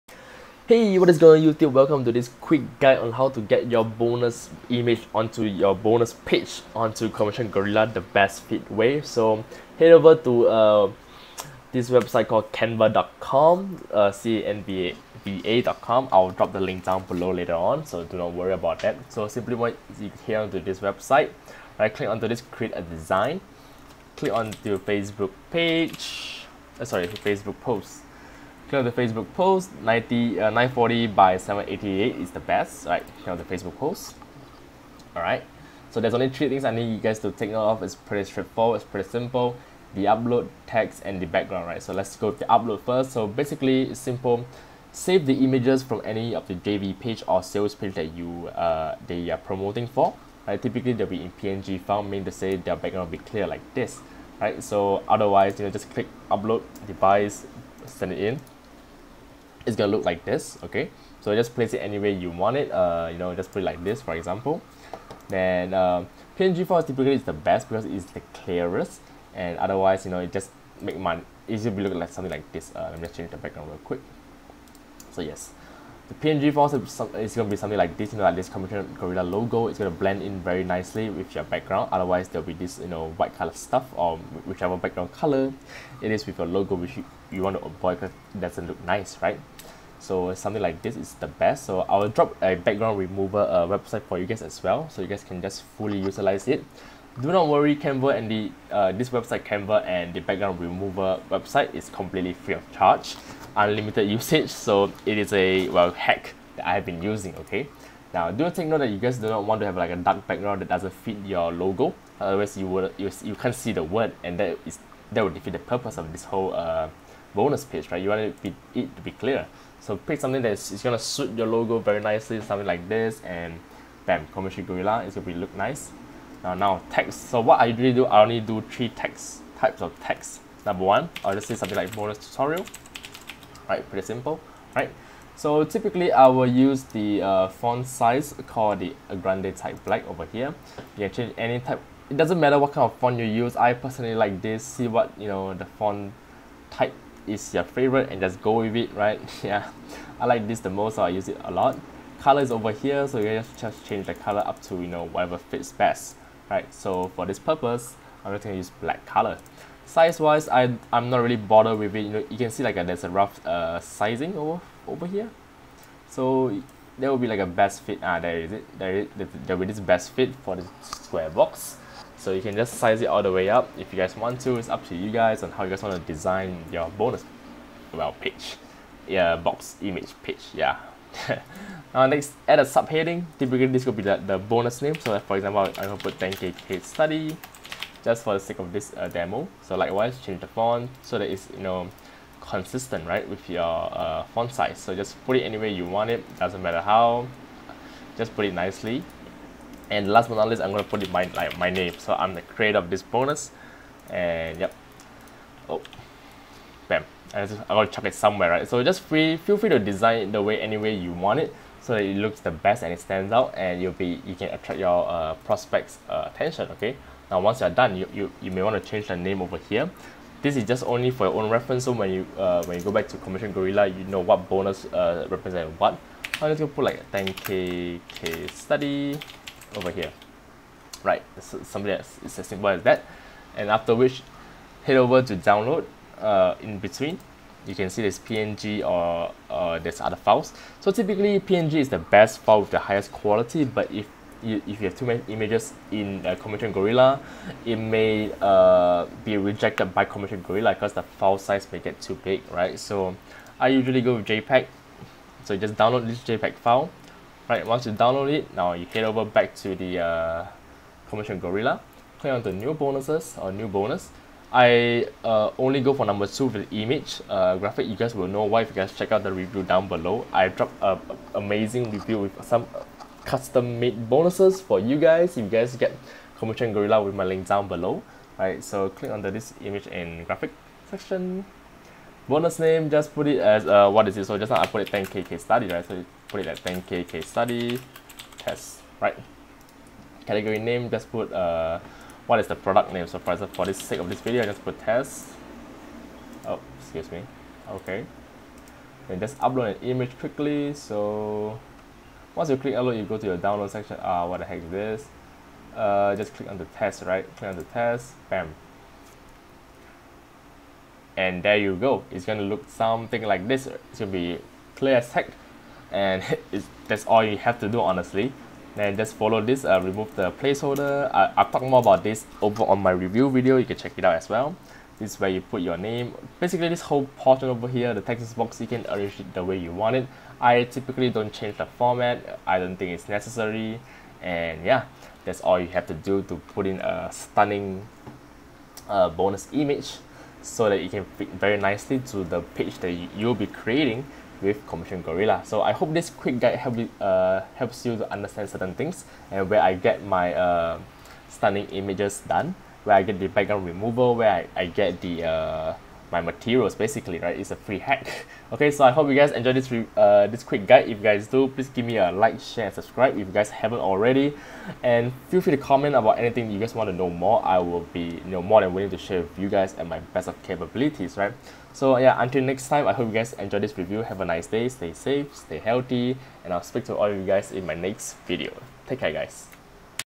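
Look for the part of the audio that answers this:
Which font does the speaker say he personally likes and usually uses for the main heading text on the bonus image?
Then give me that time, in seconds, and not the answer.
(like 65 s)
139 s.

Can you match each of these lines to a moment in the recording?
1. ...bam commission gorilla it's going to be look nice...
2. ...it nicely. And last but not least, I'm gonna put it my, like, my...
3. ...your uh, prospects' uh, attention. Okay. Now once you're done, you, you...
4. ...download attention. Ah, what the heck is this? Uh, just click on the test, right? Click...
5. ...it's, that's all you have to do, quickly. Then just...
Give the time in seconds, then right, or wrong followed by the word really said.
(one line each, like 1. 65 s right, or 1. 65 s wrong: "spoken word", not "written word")
1. 124 s right
2. 198 s right
3. 214 s right
4. 303 s wrong: "section", not "attention"
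5. 316 s wrong: "honestly", not "quickly".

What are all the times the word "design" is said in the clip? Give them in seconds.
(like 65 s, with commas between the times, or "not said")
22 s, 176 s, 209 s.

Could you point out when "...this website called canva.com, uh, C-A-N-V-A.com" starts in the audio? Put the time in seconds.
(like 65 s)
11 s.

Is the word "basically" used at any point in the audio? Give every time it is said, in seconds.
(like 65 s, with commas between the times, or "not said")
43 s, 326 s, 356 s.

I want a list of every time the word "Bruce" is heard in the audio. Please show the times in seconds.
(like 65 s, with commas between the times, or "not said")
not said.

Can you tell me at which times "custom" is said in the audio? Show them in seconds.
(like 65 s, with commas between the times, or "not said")
273 s.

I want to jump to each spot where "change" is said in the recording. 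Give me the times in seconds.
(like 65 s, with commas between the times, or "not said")
73 s, 141 s, 153 s, 190 s, 218 s, 331 s.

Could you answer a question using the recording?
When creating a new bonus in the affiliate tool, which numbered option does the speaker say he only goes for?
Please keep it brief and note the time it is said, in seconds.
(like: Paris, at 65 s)
Number two, at 266 s.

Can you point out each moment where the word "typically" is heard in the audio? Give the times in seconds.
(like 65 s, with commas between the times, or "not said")
50 s, 66 s, 135 s, 183 s, 240 s, 330 s.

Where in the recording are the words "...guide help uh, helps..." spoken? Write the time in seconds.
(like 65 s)
346 s.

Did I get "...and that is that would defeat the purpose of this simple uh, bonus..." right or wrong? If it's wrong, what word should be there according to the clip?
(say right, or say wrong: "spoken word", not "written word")
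wrong: "whole", not "simple".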